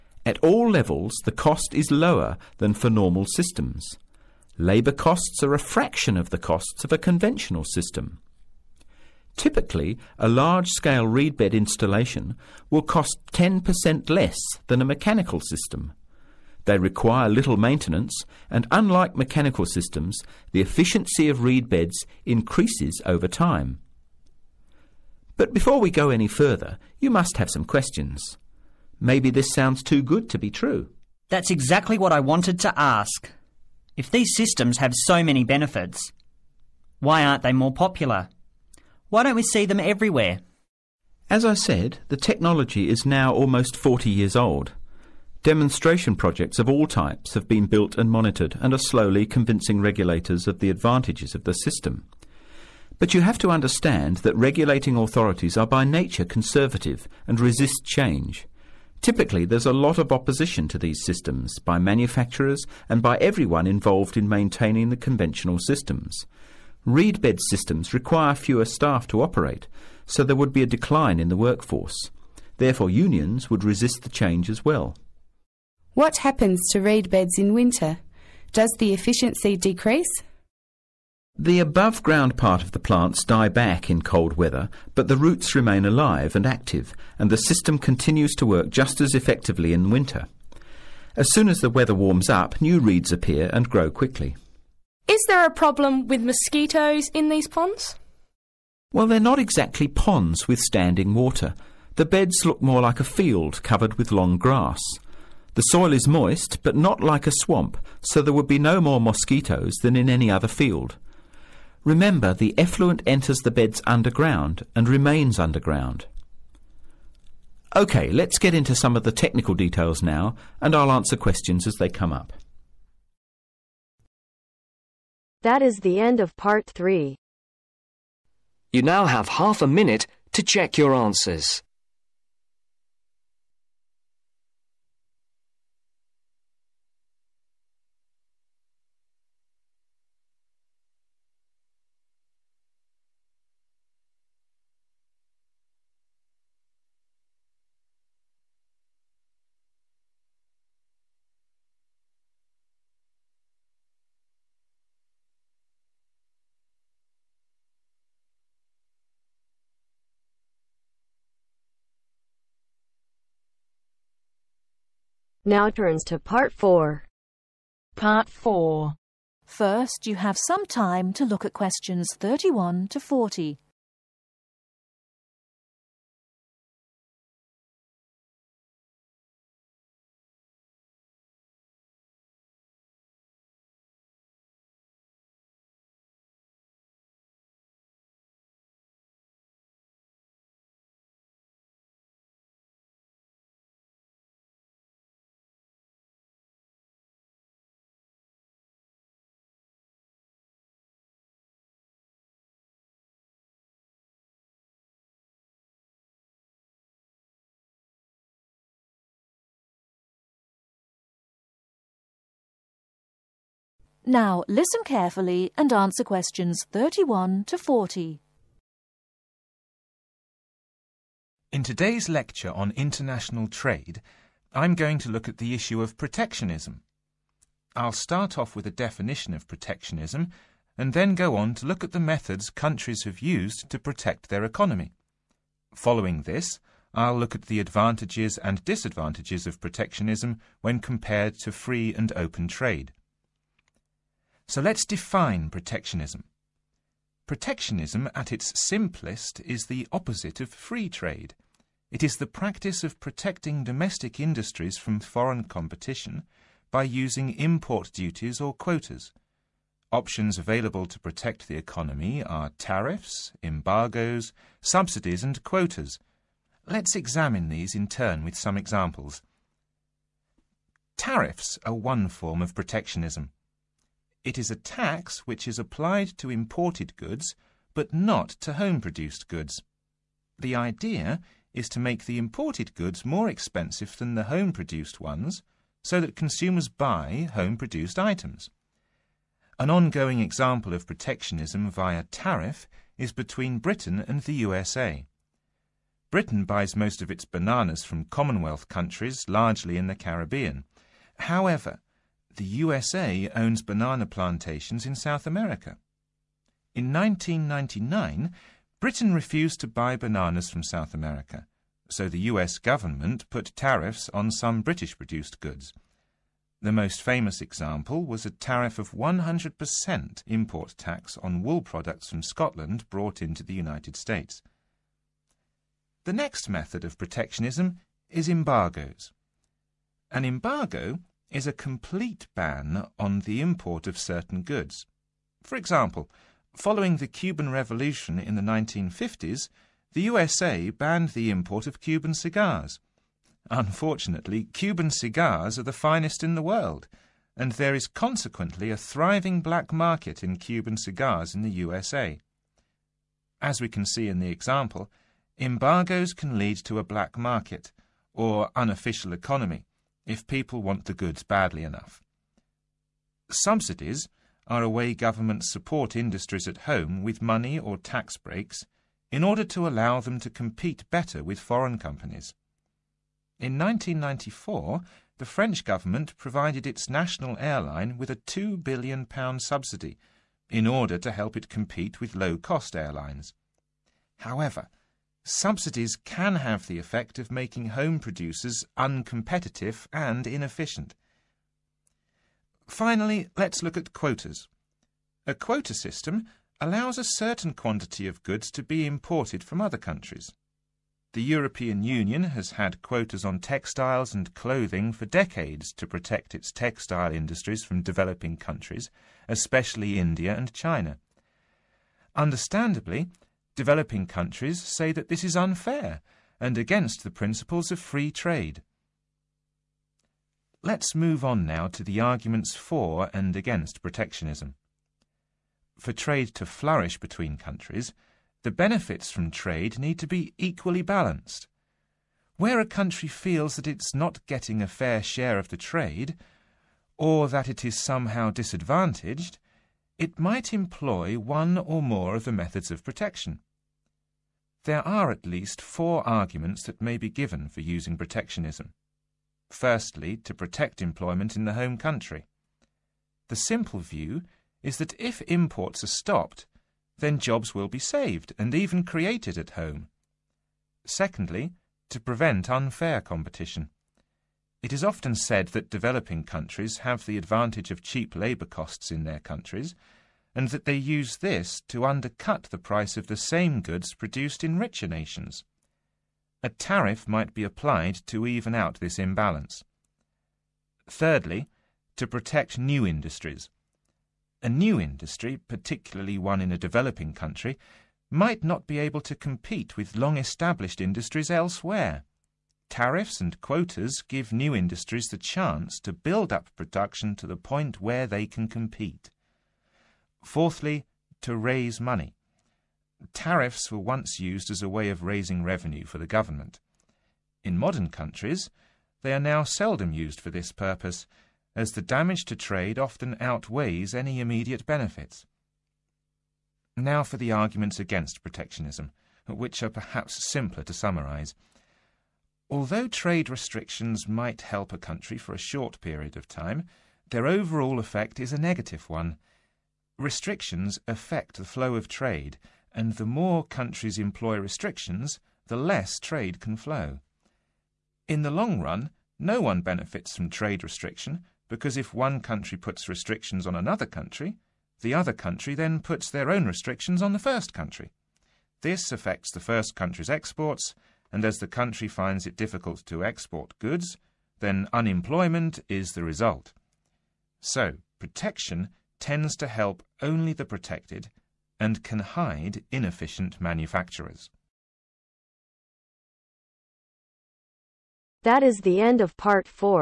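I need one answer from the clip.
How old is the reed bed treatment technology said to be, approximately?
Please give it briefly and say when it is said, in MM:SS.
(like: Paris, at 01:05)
40 years, at 00:43.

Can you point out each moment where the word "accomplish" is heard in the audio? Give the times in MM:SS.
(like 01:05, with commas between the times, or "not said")
not said.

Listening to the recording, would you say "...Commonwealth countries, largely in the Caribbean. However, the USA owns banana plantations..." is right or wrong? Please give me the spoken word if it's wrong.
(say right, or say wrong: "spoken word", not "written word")
right.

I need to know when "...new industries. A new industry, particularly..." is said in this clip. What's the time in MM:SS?
08:02.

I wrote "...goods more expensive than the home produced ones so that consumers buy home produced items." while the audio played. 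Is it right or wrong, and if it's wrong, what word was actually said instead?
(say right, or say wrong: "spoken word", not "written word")
right.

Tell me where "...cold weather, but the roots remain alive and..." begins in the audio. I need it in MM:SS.
01:24.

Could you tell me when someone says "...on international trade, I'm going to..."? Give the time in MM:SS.
03:42.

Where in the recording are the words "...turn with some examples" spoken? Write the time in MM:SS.
04:27.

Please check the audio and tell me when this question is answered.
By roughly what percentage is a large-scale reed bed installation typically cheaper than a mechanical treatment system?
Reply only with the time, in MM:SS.
00:13.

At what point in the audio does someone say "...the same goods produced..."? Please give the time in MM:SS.
07:53.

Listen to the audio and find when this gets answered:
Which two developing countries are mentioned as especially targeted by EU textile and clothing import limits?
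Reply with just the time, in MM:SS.
06:49.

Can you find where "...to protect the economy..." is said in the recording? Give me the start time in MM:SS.
04:20.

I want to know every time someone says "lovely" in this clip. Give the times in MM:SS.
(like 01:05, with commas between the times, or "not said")
not said.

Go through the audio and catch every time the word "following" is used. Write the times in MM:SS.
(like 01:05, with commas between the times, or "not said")
03:55, 05:36.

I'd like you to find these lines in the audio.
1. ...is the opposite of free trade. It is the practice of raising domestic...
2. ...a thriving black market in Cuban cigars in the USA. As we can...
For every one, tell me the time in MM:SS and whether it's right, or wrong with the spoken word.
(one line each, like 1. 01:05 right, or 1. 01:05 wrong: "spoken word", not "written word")
1. 04:09 wrong: "protecting", not "raising"
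2. 05:48 right.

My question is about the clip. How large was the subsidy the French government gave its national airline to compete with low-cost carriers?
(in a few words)
£2 billion.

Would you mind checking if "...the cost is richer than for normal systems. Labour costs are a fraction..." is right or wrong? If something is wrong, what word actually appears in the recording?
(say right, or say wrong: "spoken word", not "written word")
wrong: "lower", not "richer".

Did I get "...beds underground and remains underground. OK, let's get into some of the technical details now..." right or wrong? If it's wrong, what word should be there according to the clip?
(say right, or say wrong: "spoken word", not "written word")
right.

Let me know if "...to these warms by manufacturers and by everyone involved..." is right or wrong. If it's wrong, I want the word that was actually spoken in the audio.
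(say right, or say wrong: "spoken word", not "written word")
wrong: "systems", not "warms".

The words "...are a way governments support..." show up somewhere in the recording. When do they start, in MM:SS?
06:04.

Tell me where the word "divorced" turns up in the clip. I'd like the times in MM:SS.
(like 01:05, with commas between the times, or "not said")
not said.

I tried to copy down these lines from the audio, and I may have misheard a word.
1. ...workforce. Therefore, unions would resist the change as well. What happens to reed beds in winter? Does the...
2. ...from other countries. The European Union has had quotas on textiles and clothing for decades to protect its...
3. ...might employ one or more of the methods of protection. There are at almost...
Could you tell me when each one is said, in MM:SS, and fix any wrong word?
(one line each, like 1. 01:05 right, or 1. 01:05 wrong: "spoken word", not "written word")
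1. 01:11 right
2. 06:39 right
3. 07:20 wrong: "least", not "almost".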